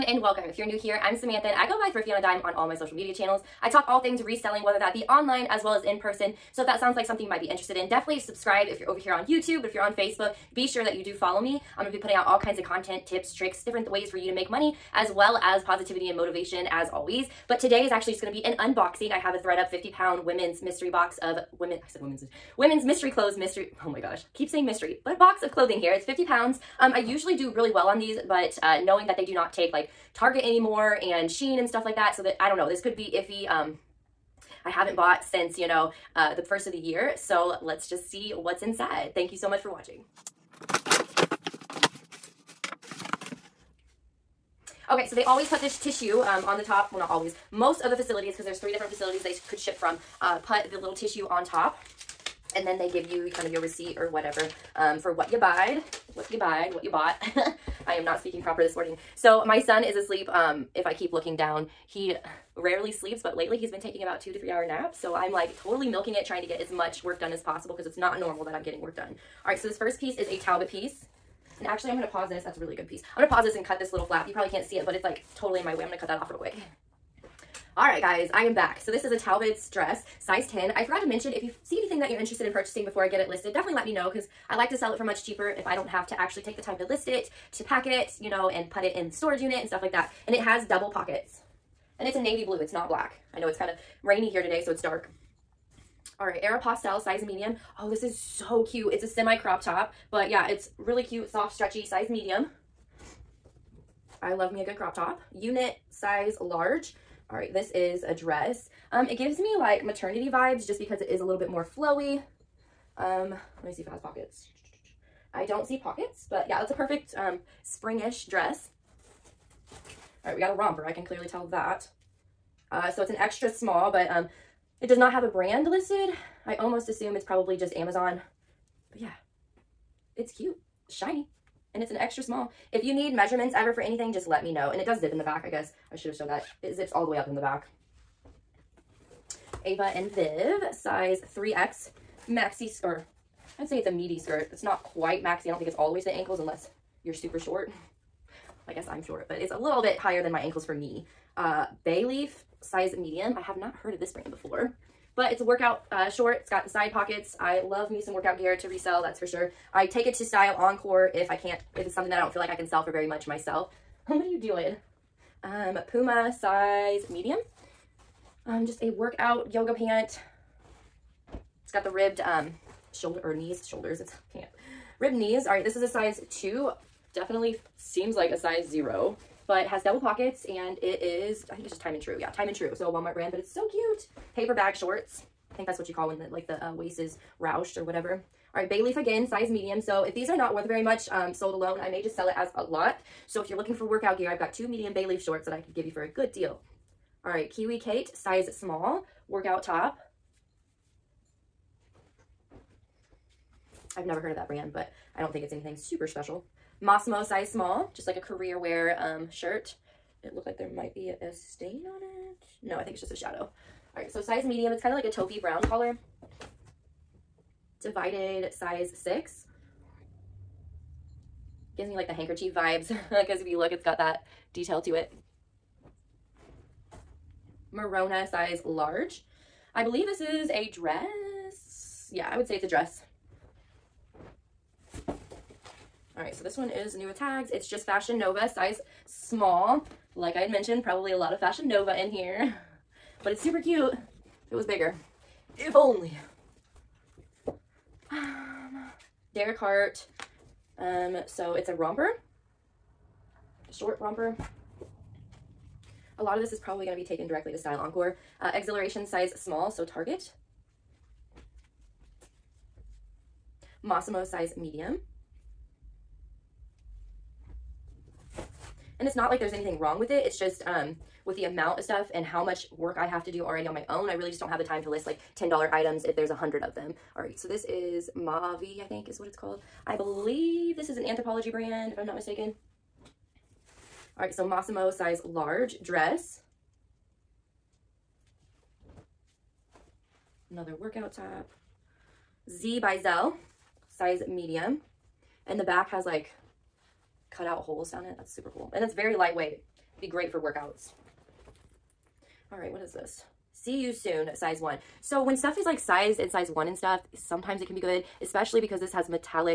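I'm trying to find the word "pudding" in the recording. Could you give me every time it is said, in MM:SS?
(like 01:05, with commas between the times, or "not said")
not said.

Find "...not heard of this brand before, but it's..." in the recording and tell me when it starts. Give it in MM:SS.
02:33.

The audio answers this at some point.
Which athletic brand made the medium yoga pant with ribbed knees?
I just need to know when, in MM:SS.
02:45.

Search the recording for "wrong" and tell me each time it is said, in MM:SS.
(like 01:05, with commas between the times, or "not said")
04:29.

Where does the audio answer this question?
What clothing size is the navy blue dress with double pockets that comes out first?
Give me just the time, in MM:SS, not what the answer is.
01:20.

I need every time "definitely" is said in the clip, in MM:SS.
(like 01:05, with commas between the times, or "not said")
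00:07, 01:23, 02:57.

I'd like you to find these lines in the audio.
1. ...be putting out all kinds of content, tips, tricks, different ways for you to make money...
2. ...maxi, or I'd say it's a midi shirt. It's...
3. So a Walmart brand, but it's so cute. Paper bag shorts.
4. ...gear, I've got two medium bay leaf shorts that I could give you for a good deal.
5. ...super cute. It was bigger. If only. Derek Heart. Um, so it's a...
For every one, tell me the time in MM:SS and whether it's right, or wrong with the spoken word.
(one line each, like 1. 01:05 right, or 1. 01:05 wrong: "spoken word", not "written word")
1. 00:11 right
2. 02:22 wrong: "skirt", not "shirt"
3. 03:02 right
4. 03:14 right
5. 04:03 right.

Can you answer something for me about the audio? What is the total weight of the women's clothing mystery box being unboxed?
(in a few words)
50 pounds.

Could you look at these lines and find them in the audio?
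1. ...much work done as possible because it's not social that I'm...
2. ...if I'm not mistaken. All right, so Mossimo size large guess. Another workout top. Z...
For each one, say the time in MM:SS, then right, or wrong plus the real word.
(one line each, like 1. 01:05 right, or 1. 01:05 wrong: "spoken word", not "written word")
1. 01:06 wrong: "normal", not "social"
2. 04:41 wrong: "dress", not "guess".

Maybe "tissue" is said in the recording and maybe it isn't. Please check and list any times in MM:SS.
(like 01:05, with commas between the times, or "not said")
00:45, 00:50.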